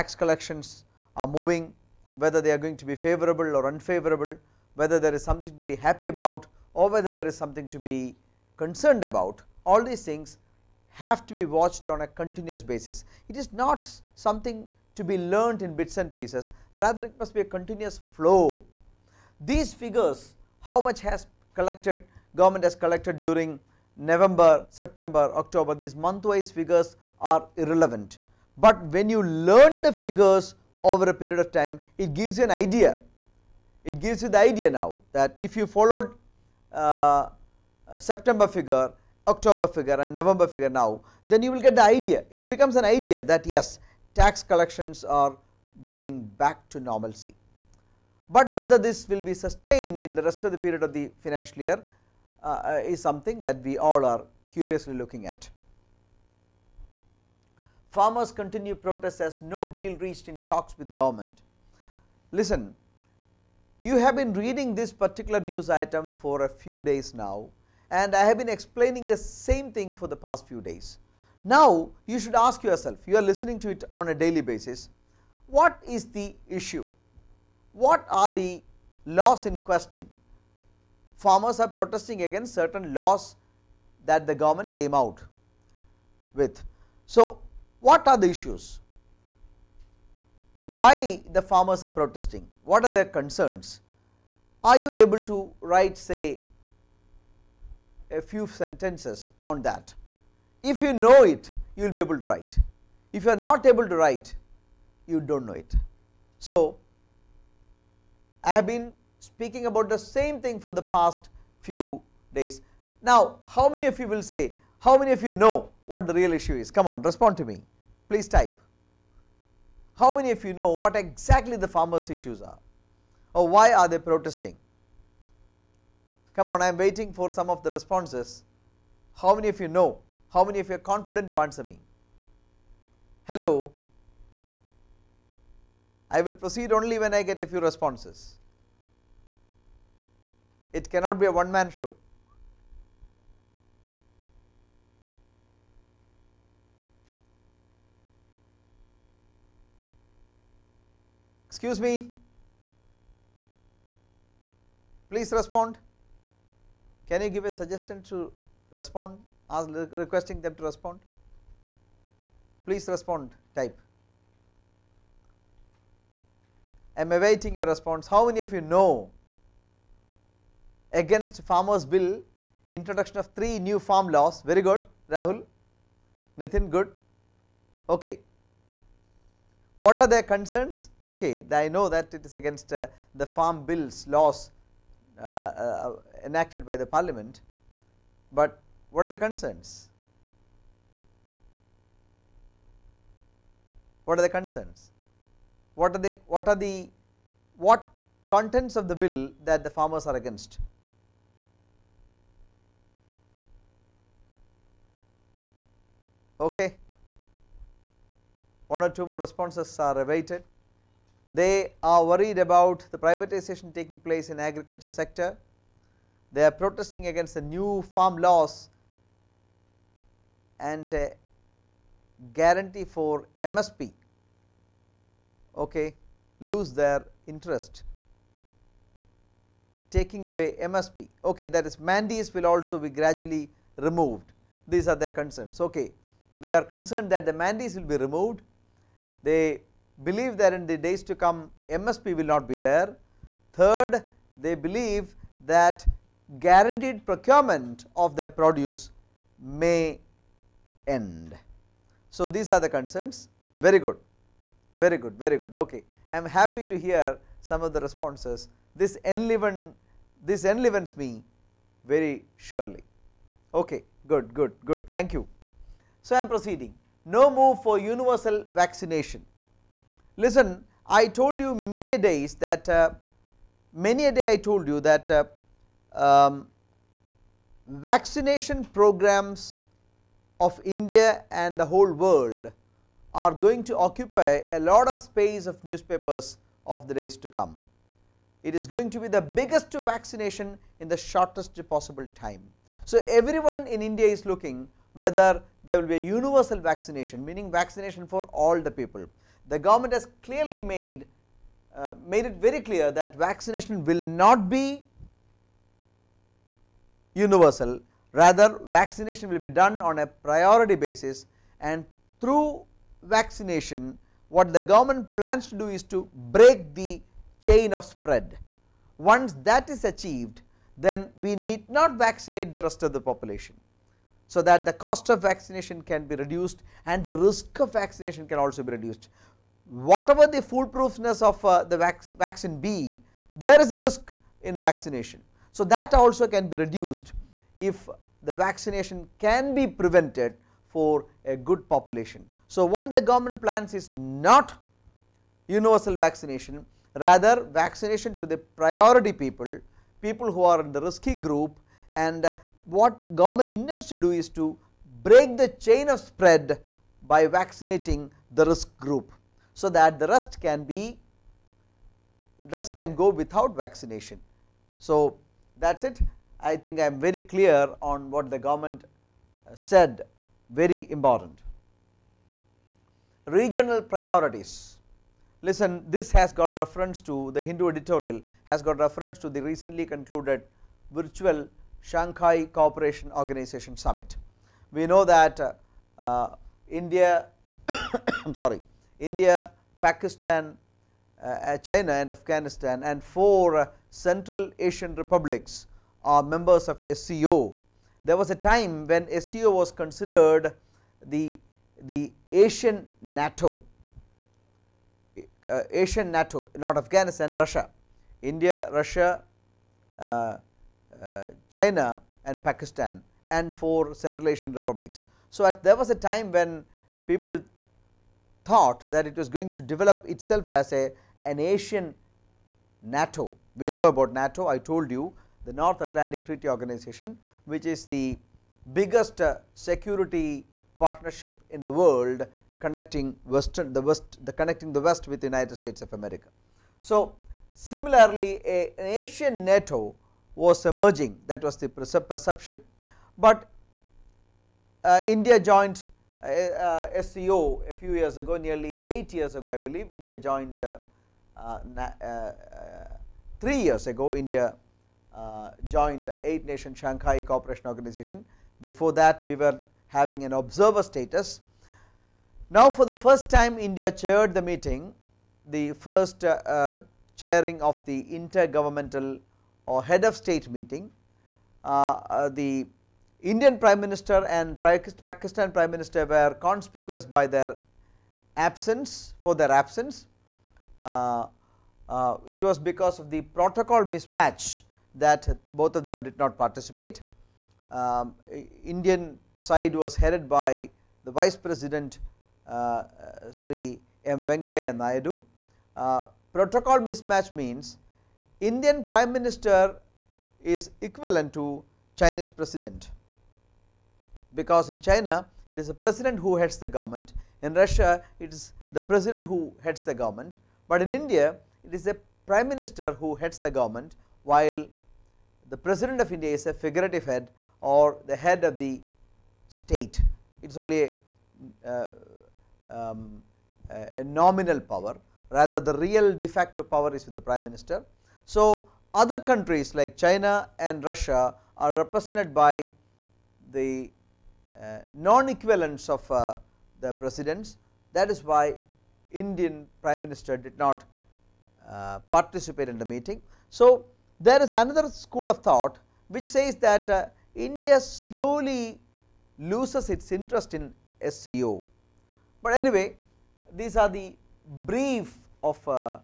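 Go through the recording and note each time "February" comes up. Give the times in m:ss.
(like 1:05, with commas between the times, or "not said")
not said.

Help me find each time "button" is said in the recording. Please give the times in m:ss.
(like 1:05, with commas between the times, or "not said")
not said.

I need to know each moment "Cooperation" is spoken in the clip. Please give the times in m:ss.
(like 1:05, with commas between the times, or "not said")
6:22, 7:37.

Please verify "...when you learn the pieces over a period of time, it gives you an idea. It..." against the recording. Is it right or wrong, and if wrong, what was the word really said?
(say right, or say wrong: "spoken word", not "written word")
wrong: "figures", not "pieces".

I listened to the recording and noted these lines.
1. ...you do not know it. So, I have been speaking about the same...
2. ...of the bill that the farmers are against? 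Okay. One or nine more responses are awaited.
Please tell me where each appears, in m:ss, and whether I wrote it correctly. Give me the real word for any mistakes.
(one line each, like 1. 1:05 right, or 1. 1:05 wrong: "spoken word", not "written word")
1. 1:45 right
2. 3:18 wrong: "two", not "nine".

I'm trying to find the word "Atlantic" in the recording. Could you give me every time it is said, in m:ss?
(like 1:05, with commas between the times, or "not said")
7:05.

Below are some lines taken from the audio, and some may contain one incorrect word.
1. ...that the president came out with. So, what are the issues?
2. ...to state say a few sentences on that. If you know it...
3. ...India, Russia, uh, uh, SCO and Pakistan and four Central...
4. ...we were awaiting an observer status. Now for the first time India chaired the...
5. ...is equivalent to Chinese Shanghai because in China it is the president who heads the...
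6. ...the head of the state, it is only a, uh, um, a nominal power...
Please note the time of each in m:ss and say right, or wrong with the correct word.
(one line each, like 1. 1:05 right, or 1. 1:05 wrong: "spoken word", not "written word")
1. 1:24 wrong: "government", not "president"
2. 1:35 wrong: "write", not "state"
3. 6:48 wrong: "China", not "SCO"
4. 7:39 wrong: "having", not "awaiting"
5. 8:20 wrong: "President", not "Shanghai"
6. 8:38 right.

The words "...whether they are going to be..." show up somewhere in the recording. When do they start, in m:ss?
0:02.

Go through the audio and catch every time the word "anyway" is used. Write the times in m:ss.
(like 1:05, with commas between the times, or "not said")
9:12.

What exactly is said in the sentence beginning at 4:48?
It is going to be the biggest vaccination in the shortest possible time.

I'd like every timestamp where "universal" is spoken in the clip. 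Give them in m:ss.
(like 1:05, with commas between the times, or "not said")
4:27, 4:55, 5:07, 5:45.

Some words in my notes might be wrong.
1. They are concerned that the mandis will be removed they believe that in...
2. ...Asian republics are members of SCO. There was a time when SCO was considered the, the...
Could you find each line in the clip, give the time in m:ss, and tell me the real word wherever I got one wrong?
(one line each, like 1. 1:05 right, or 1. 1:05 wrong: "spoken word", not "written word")
1. 3:56 right
2. 6:34 right.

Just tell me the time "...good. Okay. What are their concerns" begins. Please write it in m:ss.
2:56.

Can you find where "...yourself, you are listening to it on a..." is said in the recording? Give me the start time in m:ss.
1:12.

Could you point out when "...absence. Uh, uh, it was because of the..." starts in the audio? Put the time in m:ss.
7:59.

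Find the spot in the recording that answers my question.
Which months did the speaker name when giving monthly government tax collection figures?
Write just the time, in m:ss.
0:23.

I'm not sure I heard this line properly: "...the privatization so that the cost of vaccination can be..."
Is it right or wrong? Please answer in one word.
wrong.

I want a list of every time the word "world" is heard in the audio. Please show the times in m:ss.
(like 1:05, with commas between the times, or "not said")
4:41, 7:11.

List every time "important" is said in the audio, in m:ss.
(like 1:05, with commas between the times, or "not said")
6:10.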